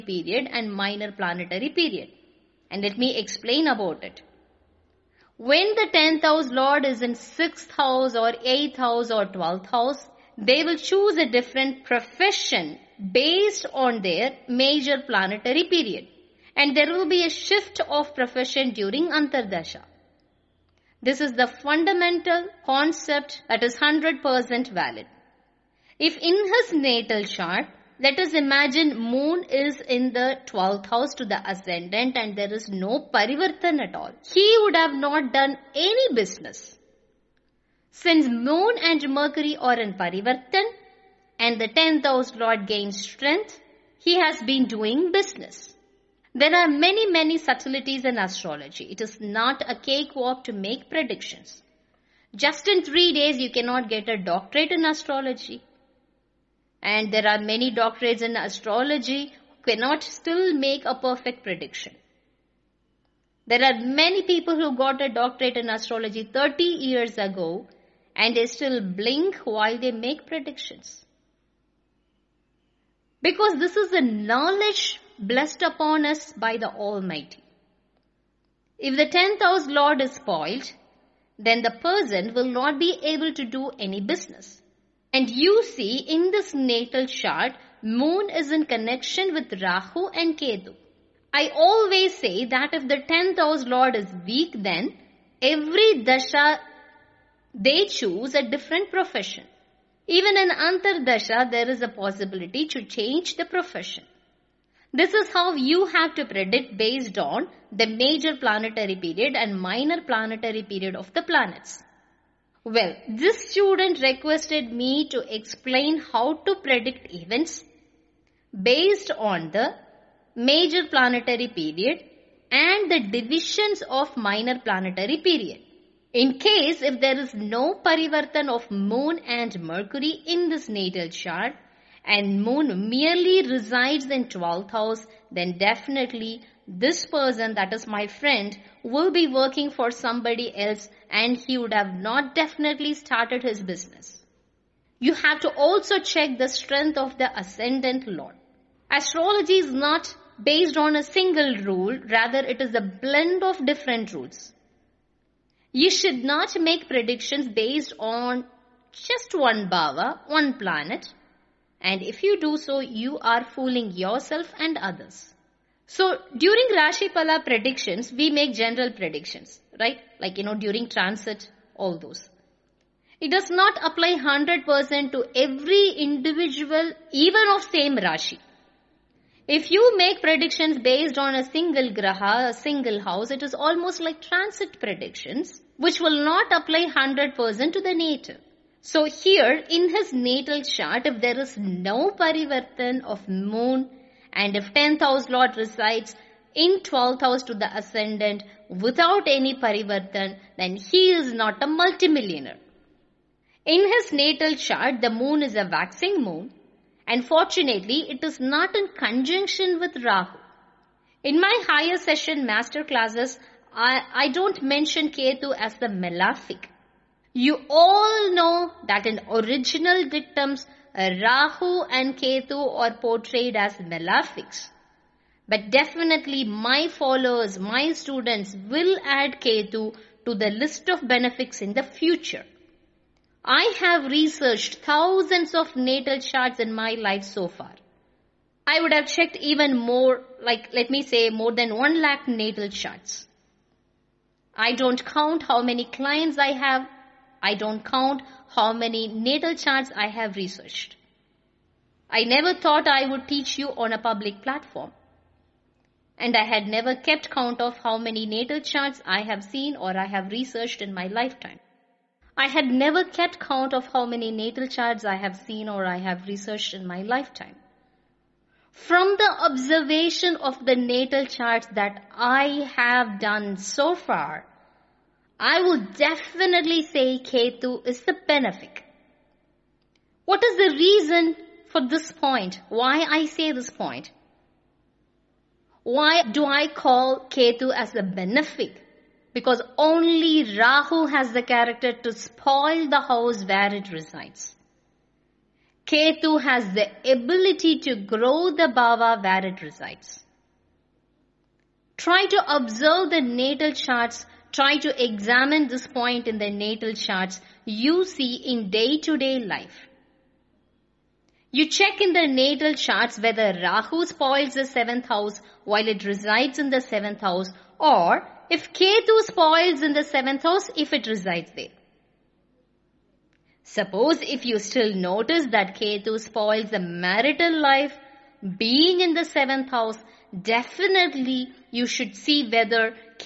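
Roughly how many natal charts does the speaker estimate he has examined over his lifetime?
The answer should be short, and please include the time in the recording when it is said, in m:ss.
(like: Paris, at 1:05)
1 lakh, at 4:01.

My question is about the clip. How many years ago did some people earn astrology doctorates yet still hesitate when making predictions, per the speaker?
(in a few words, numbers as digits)
30.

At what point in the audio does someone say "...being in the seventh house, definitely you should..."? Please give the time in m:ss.
5:28.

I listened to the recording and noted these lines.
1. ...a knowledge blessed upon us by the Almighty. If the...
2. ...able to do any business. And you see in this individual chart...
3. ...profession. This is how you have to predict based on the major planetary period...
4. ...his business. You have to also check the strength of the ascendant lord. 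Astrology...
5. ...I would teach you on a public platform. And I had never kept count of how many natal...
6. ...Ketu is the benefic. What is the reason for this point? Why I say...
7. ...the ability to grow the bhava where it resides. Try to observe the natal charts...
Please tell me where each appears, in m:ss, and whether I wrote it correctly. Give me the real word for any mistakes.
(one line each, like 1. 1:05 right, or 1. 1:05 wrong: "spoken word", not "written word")
1. 1:13 right
2. 1:23 wrong: "natal", not "individual"
3. 1:43 right
4. 2:23 right
5. 4:12 right
6. 4:37 right
7. 4:56 right.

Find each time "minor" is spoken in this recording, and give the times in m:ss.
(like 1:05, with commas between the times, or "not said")
0:00, 1:49, 2:04.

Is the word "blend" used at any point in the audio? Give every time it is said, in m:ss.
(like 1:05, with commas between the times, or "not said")
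2:32.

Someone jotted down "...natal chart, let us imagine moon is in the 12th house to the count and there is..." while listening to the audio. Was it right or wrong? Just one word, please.
wrong.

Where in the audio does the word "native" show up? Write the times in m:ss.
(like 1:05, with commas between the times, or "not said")
3:07.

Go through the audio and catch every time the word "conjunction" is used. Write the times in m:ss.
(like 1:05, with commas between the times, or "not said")
3:28.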